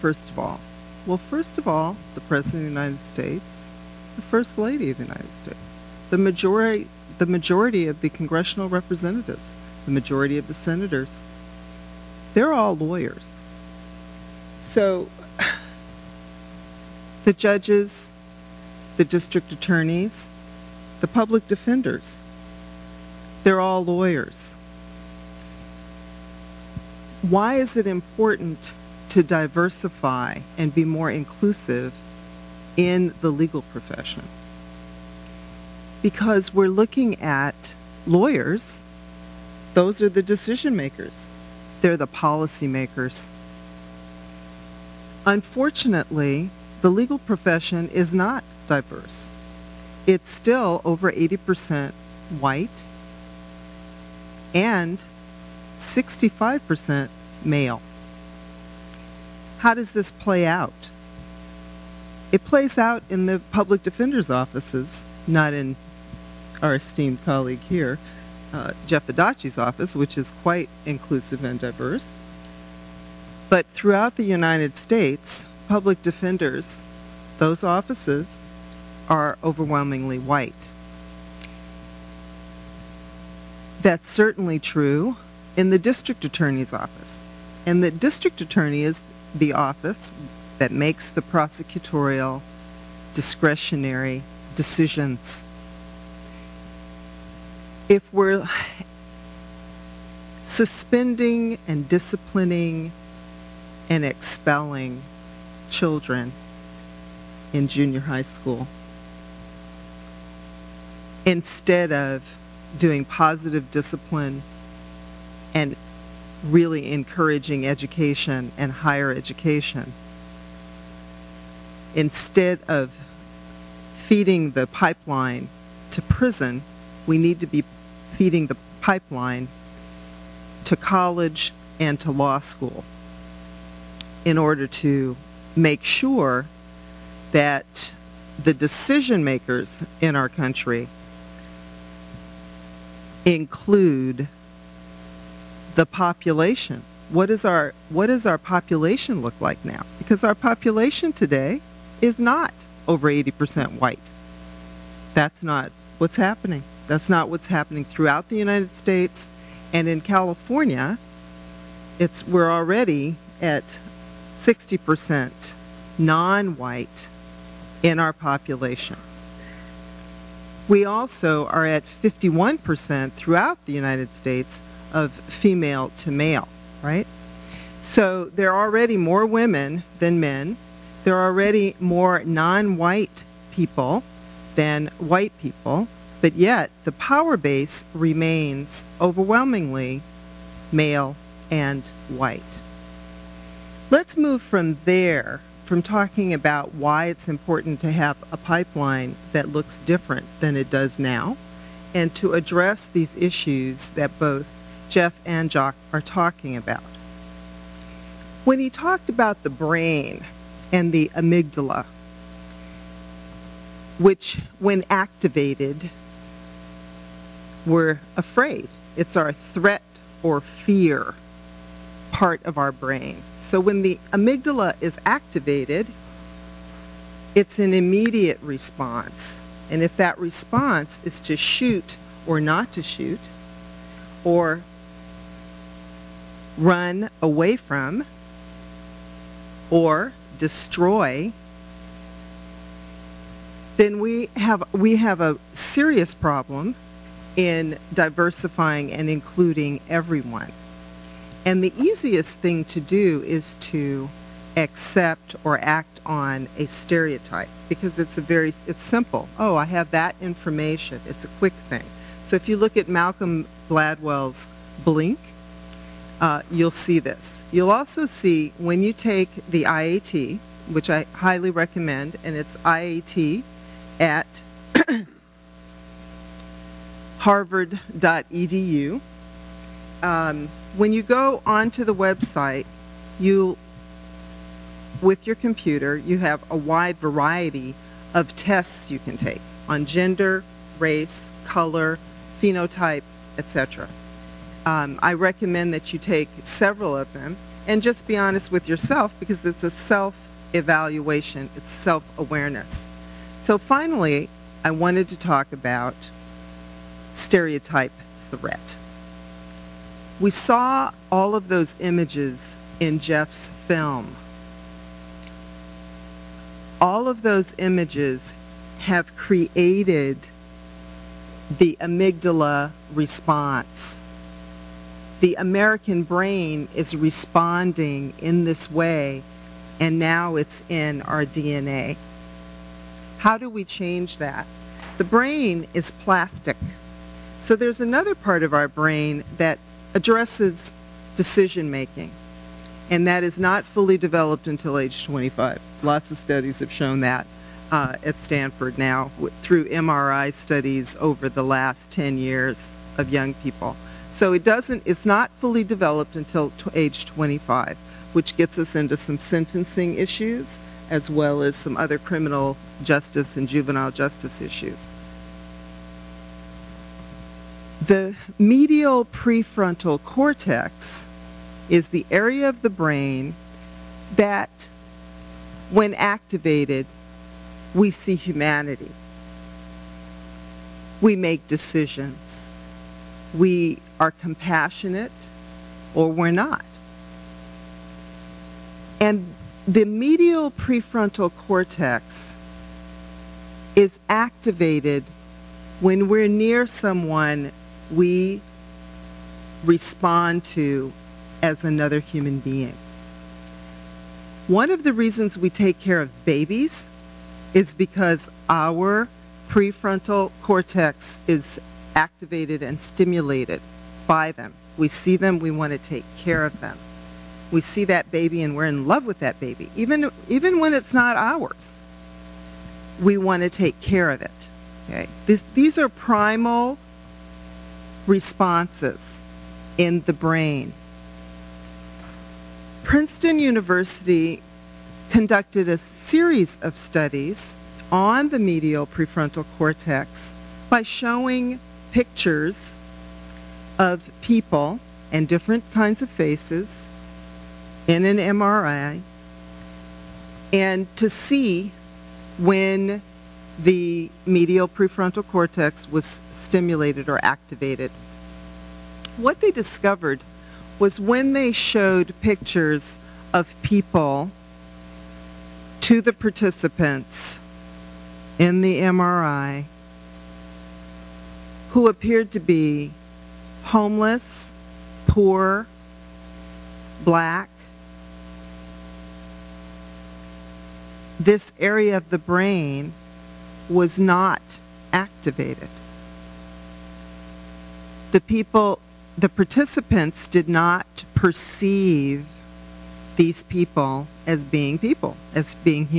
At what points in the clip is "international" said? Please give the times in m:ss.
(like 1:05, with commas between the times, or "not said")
not said.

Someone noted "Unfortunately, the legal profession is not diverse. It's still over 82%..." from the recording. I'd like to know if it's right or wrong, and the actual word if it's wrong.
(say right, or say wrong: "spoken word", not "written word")
wrong: "80", not "82".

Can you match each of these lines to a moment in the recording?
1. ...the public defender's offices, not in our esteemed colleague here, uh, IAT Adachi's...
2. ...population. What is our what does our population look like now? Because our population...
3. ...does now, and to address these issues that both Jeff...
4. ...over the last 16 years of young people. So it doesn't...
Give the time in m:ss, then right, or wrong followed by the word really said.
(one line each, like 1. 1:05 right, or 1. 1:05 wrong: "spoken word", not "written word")
1. 1:03 wrong: "Jeff", not "IAT"
2. 2:25 right
3. 3:20 right
4. 5:51 wrong: "10", not "16".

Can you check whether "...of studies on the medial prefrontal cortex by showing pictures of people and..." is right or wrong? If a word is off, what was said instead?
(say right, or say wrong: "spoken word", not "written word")
right.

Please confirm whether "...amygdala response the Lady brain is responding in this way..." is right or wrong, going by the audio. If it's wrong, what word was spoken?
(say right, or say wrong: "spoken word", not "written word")
wrong: "American", not "Lady".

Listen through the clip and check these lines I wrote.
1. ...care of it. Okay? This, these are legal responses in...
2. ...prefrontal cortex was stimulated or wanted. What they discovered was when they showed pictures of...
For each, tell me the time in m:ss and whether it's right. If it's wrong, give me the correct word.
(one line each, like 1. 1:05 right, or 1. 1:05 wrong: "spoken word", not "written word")
1. 7:03 wrong: "primal", not "legal"
2. 7:34 wrong: "activated", not "wanted".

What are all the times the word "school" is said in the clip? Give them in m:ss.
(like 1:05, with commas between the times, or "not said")
1:48, 2:12.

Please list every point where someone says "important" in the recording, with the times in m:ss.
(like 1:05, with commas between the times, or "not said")
0:27, 3:17.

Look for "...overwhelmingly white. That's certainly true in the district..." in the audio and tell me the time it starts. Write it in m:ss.
1:19.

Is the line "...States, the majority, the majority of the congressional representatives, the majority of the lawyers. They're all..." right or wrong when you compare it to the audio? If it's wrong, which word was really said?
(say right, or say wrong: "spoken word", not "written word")
wrong: "senators", not "lawyers".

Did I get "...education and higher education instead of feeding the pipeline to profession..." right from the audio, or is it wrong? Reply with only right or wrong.
wrong.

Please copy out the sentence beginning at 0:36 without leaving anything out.
Because we're looking at lawyers, those are the decision makers.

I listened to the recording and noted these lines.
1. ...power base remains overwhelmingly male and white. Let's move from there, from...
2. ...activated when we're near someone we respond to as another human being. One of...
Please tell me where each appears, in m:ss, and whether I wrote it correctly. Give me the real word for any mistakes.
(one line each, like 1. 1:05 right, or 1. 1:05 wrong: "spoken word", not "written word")
1. 3:06 right
2. 6:34 right.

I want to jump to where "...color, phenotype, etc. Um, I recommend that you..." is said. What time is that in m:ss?
4:51.